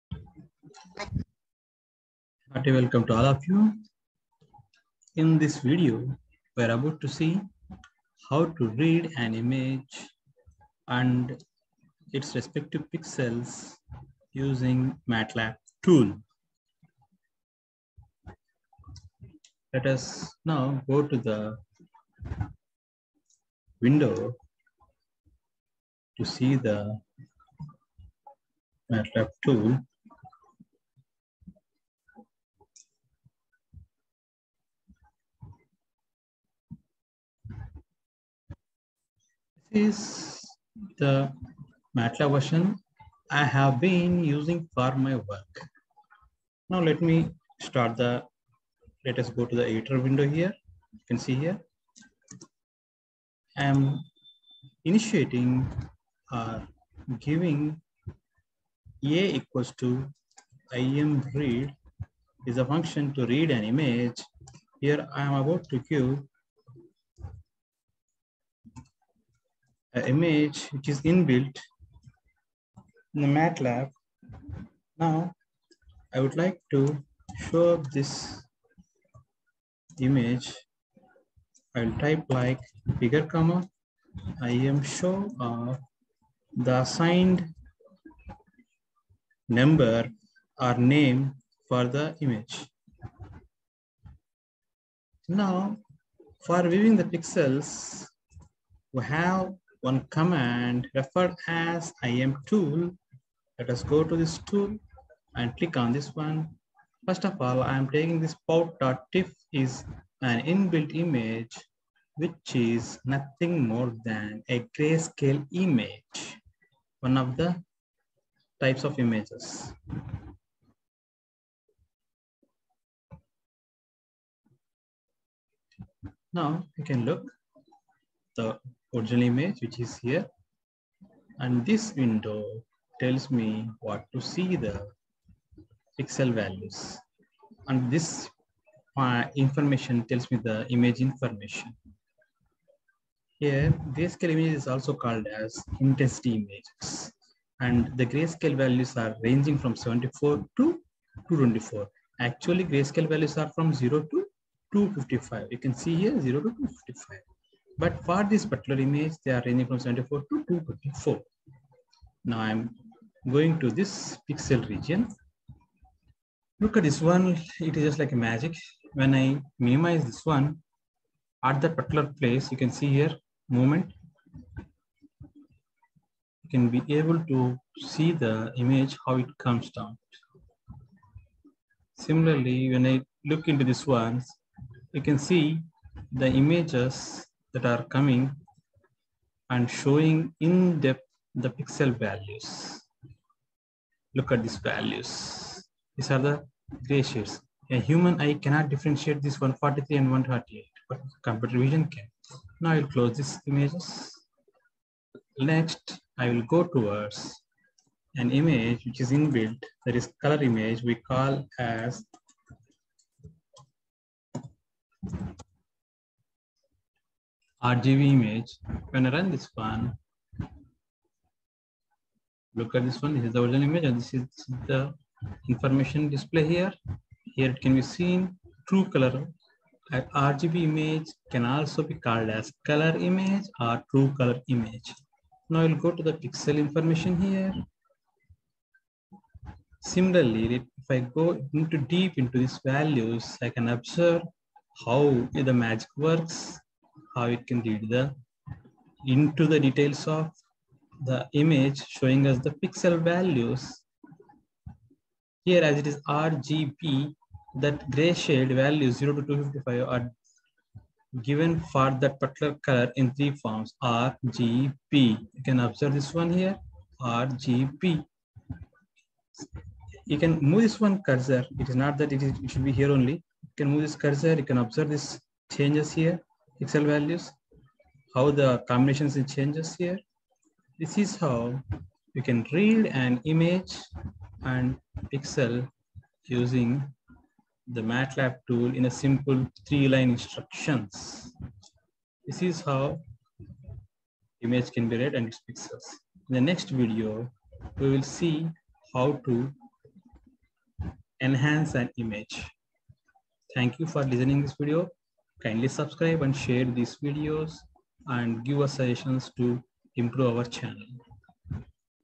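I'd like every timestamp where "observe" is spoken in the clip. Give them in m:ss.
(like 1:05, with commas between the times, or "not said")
4:03, 4:25, 4:34.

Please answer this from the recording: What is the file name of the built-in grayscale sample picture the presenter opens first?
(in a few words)
pout.tiff.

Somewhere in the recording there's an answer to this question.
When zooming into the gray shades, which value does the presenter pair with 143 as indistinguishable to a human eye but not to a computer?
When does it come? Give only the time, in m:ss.
3:20.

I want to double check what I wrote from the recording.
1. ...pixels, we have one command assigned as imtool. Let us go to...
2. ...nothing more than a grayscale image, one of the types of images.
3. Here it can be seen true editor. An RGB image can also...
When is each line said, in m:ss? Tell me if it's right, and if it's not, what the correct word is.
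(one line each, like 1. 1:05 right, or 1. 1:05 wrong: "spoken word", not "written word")
1. 1:37 wrong: "referred", not "assigned"
2. 1:53 right
3. 3:47 wrong: "color", not "editor".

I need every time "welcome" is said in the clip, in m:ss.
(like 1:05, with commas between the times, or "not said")
0:02.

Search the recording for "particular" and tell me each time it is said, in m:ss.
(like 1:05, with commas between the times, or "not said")
2:38, 2:51, 4:22.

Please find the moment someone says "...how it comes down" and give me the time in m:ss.
2:59.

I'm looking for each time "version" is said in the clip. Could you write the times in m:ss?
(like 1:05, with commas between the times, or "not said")
0:42.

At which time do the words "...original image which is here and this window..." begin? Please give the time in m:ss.
2:08.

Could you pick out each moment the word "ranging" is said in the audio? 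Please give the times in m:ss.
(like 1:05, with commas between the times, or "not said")
2:29, 2:39.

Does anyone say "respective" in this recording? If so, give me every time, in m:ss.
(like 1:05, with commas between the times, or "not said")
0:12.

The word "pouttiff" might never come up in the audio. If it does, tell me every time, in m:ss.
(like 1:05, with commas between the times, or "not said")
1:48.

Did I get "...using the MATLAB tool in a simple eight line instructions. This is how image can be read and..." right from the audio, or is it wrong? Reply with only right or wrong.
wrong.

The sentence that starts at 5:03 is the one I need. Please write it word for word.
Thank you for listening this video.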